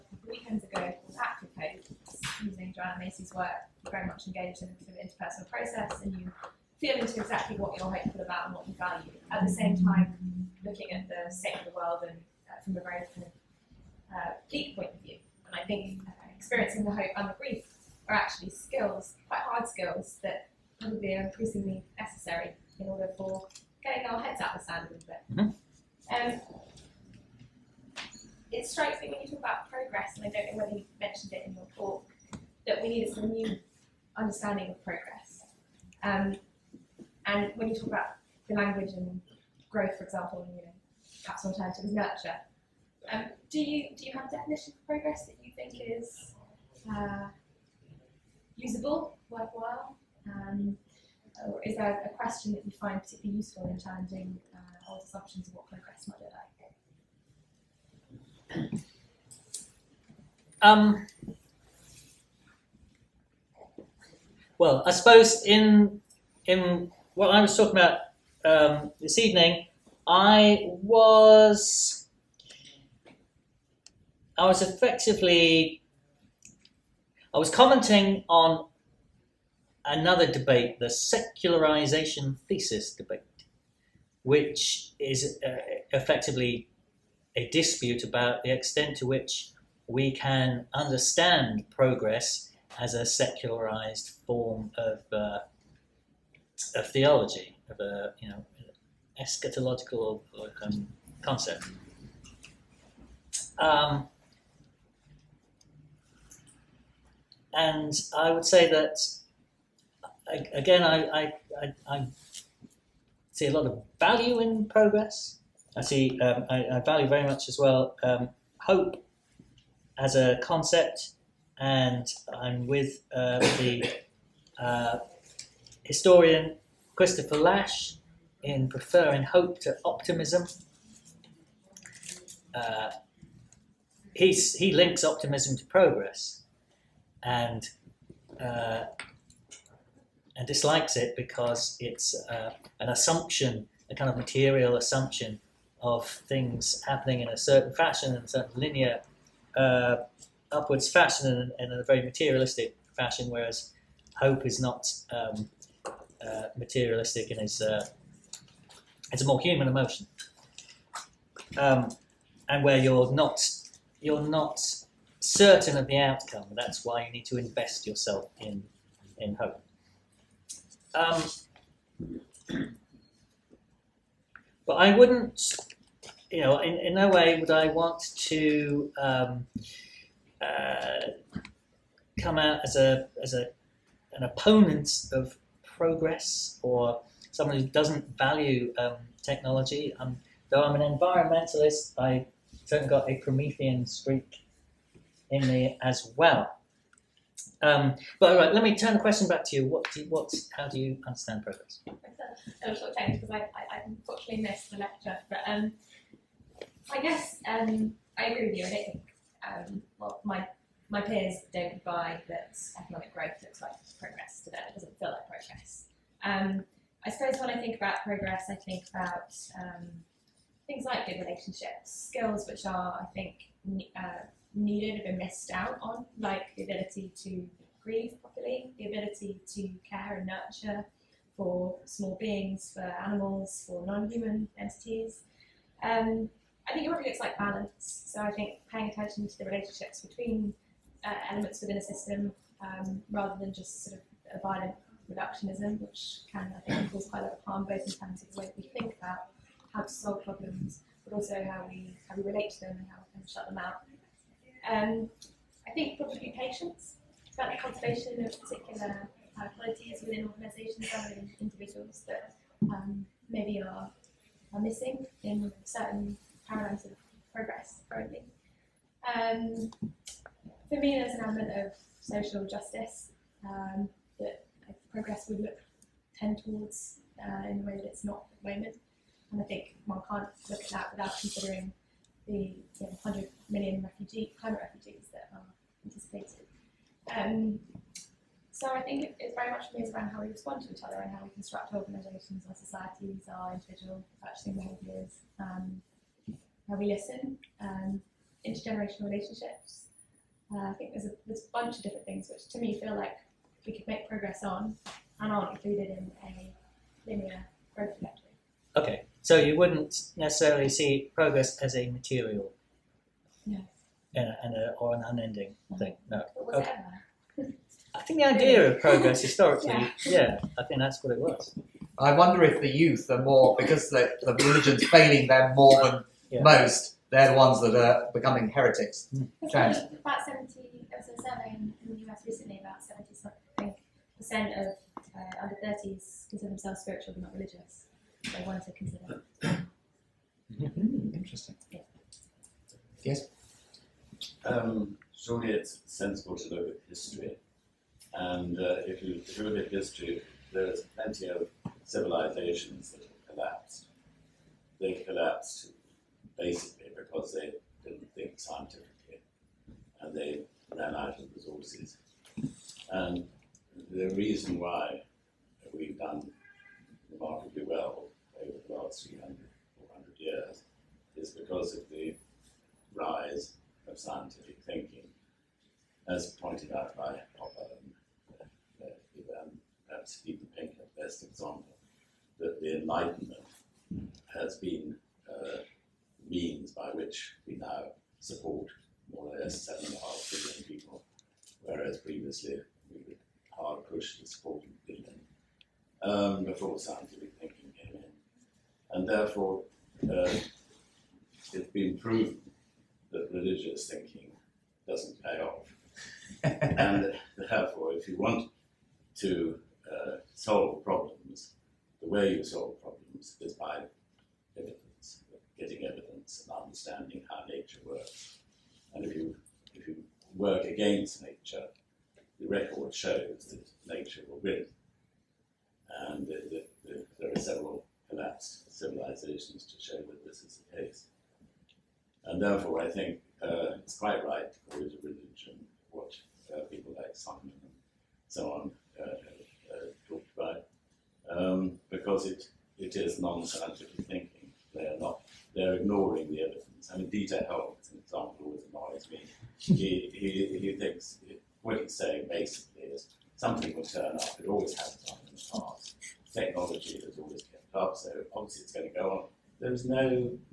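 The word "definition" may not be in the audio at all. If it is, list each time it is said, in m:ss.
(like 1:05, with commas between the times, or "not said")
0:44.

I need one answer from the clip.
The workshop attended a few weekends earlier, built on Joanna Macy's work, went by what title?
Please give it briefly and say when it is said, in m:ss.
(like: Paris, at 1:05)
Active Hope, at 0:01.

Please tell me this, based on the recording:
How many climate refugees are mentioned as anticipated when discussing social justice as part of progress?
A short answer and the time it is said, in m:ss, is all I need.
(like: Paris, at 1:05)
100 million, at 4:43.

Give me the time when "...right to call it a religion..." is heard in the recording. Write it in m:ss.
7:14.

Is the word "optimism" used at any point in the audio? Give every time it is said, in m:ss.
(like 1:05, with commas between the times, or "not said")
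2:09, 2:15.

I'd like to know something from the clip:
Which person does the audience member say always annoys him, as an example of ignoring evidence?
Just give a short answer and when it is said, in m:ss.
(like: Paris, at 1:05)
Dieter Helm, at 7:27.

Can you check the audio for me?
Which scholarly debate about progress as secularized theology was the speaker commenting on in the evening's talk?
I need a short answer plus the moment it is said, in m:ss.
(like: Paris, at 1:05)
secularization thesis debate, at 1:20.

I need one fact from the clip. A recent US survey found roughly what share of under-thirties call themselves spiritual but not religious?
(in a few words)
seventy something percent.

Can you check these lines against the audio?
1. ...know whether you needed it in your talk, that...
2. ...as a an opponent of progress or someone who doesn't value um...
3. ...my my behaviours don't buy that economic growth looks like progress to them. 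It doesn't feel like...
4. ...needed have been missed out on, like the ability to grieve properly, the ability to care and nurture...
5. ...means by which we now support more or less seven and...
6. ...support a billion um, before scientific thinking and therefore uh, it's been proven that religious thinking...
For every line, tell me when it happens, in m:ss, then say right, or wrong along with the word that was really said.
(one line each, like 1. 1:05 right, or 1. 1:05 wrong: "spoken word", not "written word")
1. 0:30 wrong: "mentioned", not "needed"
2. 3:03 right
3. 3:30 wrong: "peers", not "behaviours"
4. 3:44 right
5. 6:26 right
6. 6:34 right.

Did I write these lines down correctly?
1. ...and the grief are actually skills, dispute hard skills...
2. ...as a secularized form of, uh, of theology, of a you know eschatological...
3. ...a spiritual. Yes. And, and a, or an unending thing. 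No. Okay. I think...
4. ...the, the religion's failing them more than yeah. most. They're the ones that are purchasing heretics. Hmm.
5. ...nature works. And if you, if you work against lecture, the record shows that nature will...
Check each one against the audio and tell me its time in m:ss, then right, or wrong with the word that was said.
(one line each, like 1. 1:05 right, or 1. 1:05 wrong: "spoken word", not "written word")
1. 0:17 wrong: "quite", not "dispute"
2. 1:32 right
3. 5:11 wrong: "material", not "spiritual"
4. 5:23 wrong: "becoming", not "purchasing"
5. 6:57 wrong: "nature", not "lecture".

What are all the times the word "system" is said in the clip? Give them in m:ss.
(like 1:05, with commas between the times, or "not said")
4:01.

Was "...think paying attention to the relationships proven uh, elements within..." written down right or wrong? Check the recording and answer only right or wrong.
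wrong.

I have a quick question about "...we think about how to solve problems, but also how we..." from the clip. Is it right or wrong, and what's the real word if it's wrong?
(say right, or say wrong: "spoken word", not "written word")
right.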